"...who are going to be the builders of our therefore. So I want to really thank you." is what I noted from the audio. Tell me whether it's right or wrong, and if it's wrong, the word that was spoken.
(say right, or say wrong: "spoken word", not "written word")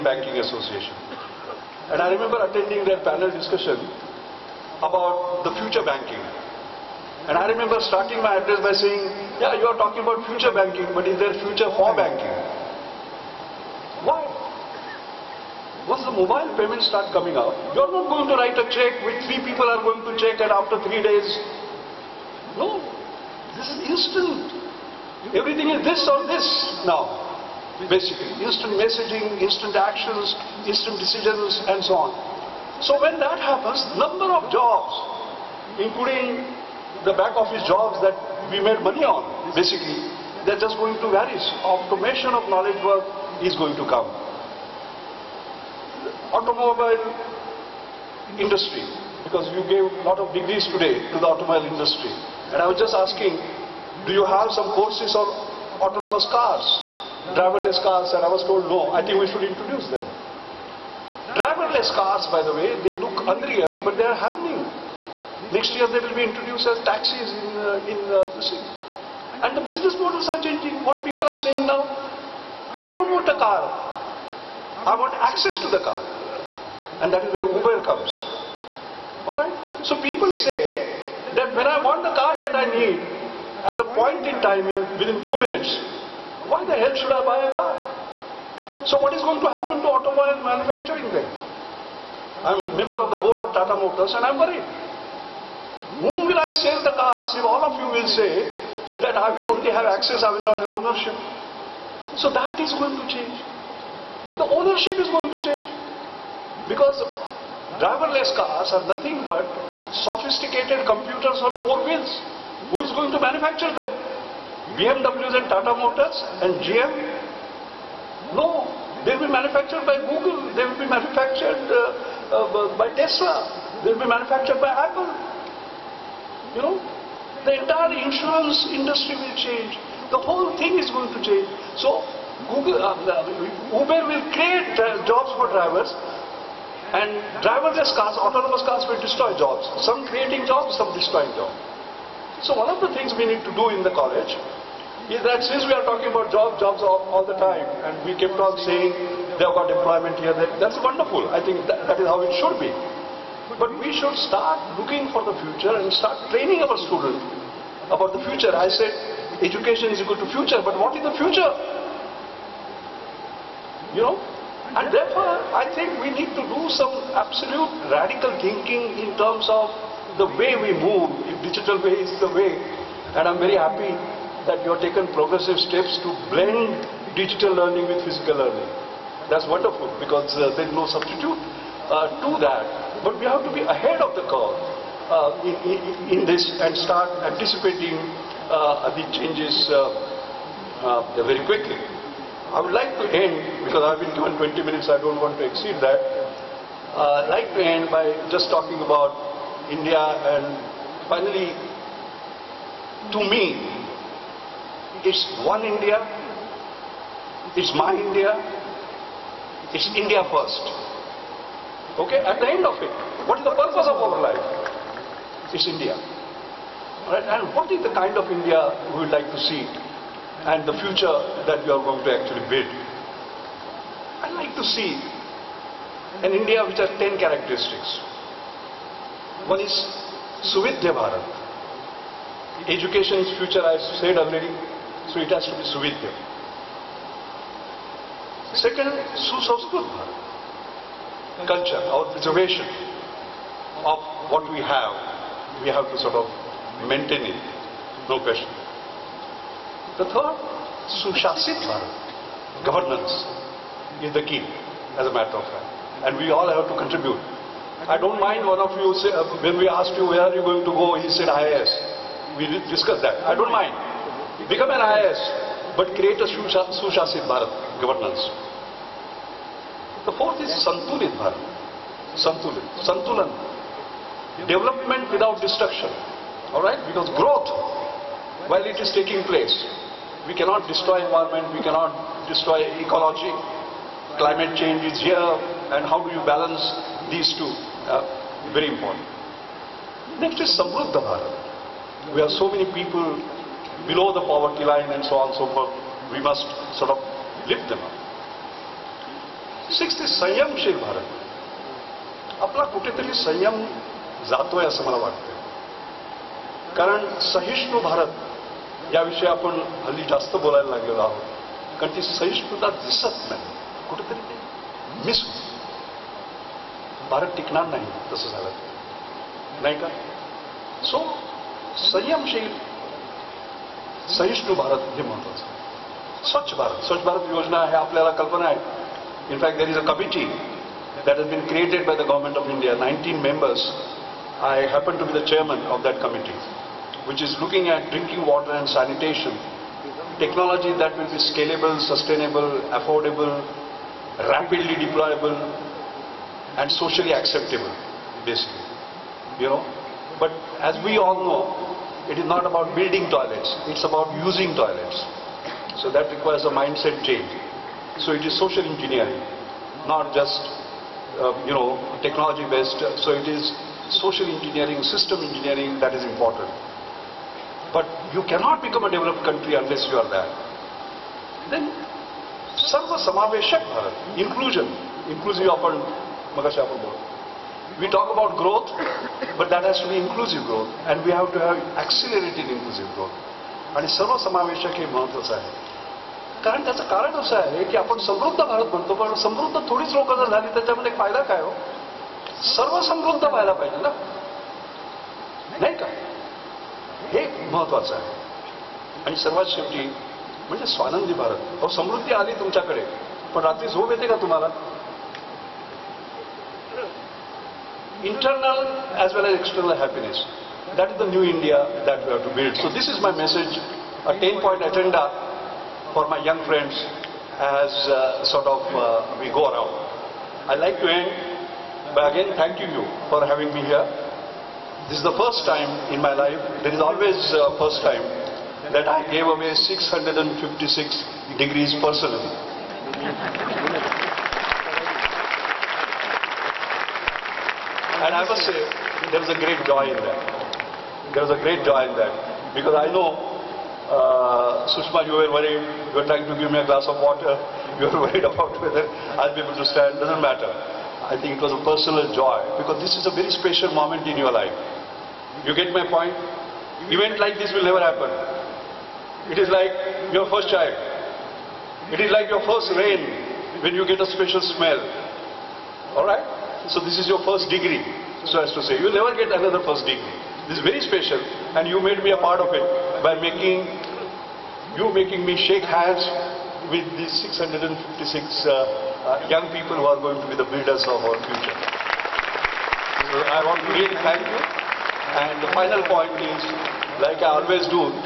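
wrong: "future", not "therefore".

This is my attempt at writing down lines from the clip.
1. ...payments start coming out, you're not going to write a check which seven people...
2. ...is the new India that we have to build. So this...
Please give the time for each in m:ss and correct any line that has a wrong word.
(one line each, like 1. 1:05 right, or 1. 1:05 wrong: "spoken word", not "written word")
1. 0:16 wrong: "three", not "seven"
2. 6:50 right.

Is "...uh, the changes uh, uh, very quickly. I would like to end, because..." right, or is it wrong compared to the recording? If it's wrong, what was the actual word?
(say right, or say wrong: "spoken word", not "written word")
right.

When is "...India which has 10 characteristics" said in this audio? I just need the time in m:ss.
3:46.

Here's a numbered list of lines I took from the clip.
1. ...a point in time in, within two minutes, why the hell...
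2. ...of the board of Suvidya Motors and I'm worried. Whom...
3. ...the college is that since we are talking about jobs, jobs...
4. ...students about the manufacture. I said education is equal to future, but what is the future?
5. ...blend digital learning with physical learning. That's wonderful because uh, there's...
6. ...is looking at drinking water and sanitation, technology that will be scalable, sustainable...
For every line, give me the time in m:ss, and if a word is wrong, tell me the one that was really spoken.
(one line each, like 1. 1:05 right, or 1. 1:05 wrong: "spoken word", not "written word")
1. 1:23 right
2. 1:33 wrong: "Tata", not "Suvidya"
3. 2:23 right
4. 2:36 wrong: "future", not "manufacture"
5. 2:56 right
6. 5:37 right.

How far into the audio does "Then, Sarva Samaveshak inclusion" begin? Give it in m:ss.
6:11.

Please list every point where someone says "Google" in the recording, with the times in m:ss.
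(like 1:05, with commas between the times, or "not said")
2:00, 2:12.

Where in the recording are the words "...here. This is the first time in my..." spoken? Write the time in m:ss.
7:03.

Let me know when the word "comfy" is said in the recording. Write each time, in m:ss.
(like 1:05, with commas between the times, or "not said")
not said.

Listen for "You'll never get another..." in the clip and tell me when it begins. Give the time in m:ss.
7:48.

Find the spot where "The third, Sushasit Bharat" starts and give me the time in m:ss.
4:09.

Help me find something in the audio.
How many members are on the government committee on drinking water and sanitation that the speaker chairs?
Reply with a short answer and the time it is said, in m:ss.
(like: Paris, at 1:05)
19, at 5:32.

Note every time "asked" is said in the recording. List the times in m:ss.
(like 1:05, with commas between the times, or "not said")
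4:19.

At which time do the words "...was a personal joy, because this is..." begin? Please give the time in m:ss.
7:31.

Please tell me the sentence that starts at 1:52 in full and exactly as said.
Who is going to manufacture them?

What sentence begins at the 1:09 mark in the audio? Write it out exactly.
And the business models are changing.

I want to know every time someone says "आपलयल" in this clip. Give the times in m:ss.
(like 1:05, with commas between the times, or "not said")
5:27.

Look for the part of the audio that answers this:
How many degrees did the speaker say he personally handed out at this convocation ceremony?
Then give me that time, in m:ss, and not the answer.
7:09.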